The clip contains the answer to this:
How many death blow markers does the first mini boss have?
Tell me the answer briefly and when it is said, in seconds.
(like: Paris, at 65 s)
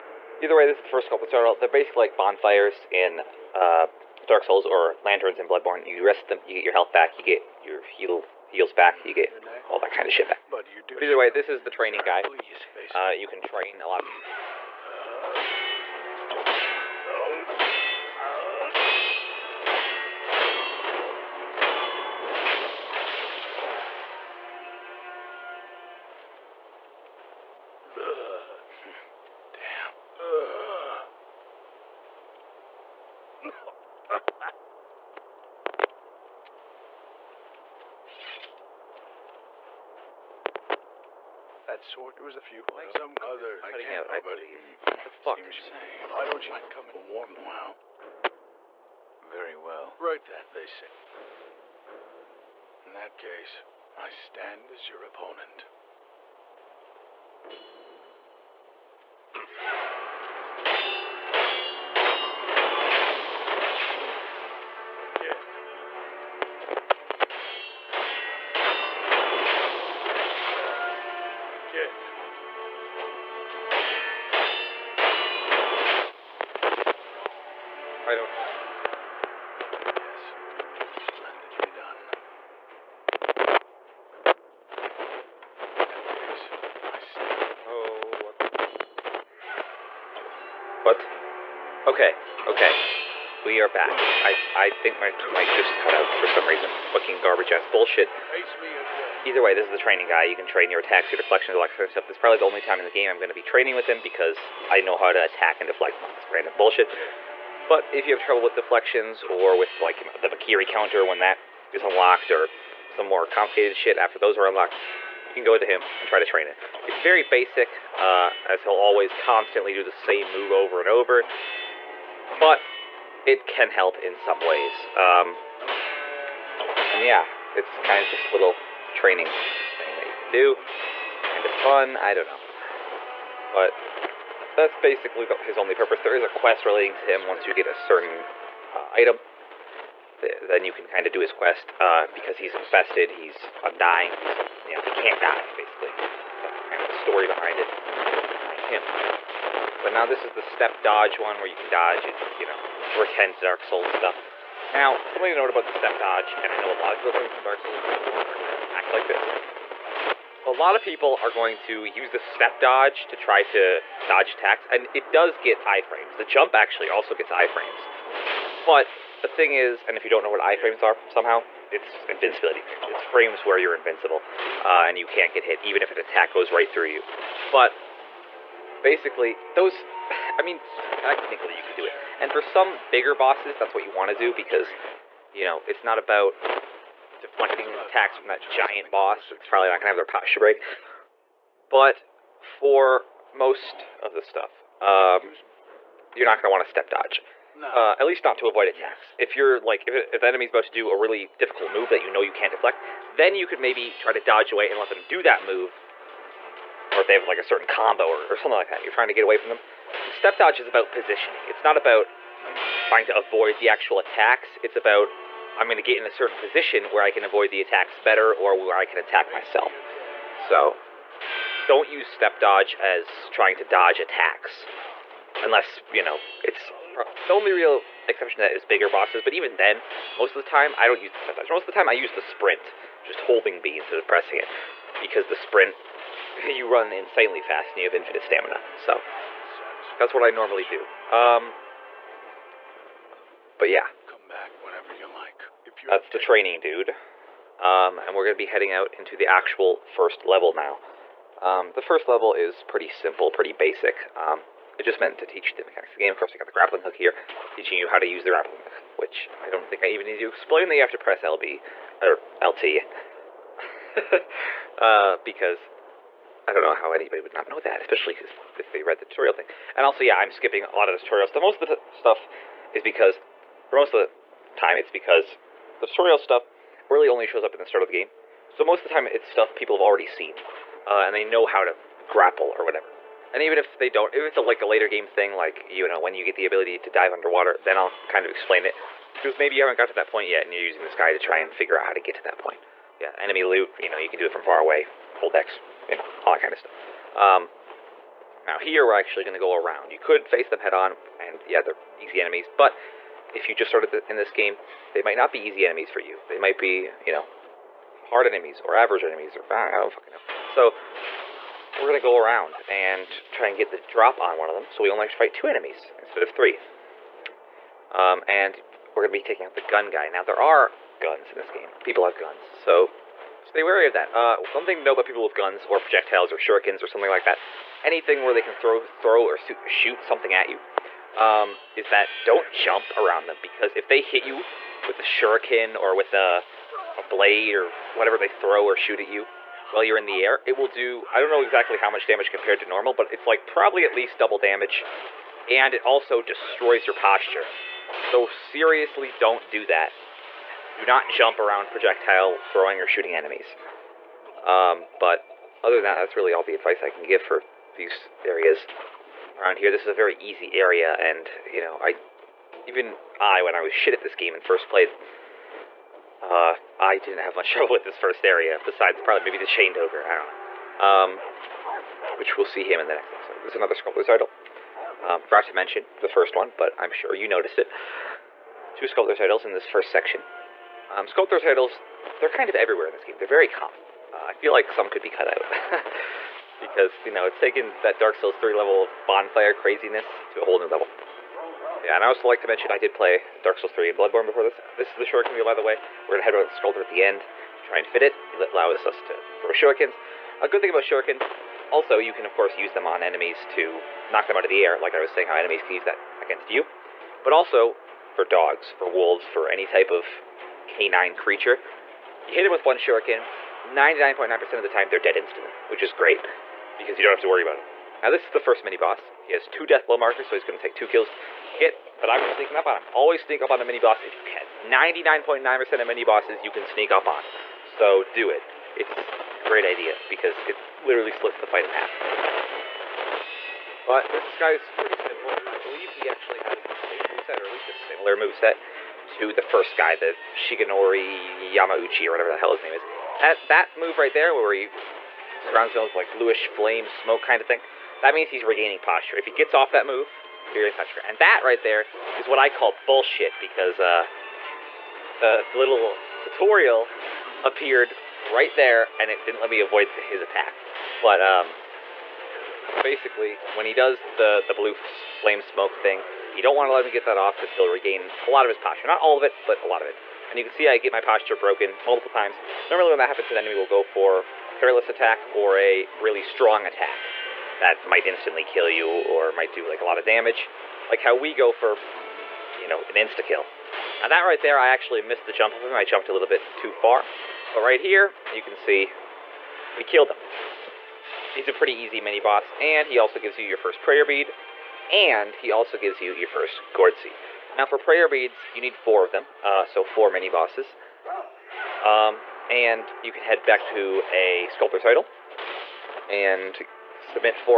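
2, at 419 s.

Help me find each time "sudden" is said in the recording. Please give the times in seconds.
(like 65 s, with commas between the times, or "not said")
not said.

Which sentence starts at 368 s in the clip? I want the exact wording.
Besides, probably maybe the chained ogre.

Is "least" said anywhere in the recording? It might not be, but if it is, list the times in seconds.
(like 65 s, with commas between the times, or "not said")
198 s, 343 s, 437 s.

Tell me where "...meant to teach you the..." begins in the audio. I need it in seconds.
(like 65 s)
254 s.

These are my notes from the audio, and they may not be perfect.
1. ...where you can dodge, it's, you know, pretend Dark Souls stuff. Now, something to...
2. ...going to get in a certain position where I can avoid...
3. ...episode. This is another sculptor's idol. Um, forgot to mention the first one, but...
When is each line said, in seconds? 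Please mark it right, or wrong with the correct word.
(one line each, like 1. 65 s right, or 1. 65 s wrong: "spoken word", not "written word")
1. 151 s right
2. 215 s right
3. 373 s right.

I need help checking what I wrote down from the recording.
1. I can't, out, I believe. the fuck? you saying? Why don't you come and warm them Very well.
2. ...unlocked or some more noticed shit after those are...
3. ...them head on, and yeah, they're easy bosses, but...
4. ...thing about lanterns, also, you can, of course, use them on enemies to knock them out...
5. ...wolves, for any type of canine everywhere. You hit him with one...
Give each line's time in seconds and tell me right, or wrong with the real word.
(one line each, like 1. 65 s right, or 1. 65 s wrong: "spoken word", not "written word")
1. 43 s right
2. 111 s wrong: "complicated", not "noticed"
3. 300 s wrong: "enemies", not "bosses"
4. 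400 s wrong: "shurikens", not "lanterns"
5. 408 s wrong: "creature", not "everywhere".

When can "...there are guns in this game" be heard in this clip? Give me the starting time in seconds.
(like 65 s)
320 s.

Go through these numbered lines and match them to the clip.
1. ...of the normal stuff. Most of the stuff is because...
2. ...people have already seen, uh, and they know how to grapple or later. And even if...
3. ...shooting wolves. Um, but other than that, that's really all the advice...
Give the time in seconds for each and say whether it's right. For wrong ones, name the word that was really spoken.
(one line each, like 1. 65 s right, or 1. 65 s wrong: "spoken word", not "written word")
1. 270 s wrong: "tutorial", not "normal"
2. 279 s wrong: "whatever", not "later"
3. 352 s wrong: "enemies", not "wolves".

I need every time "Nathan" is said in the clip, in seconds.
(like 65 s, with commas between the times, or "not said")
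not said.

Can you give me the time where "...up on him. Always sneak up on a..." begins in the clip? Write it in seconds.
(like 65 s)
422 s.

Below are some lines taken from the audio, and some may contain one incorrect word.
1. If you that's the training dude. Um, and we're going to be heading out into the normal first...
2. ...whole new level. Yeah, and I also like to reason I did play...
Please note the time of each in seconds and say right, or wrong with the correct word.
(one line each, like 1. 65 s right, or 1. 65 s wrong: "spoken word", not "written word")
1. 245 s wrong: "actual", not "normal"
2. 390 s wrong: "mention", not "reason".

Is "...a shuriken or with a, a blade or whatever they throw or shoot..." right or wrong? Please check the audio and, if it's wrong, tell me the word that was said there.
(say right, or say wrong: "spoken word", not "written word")
right.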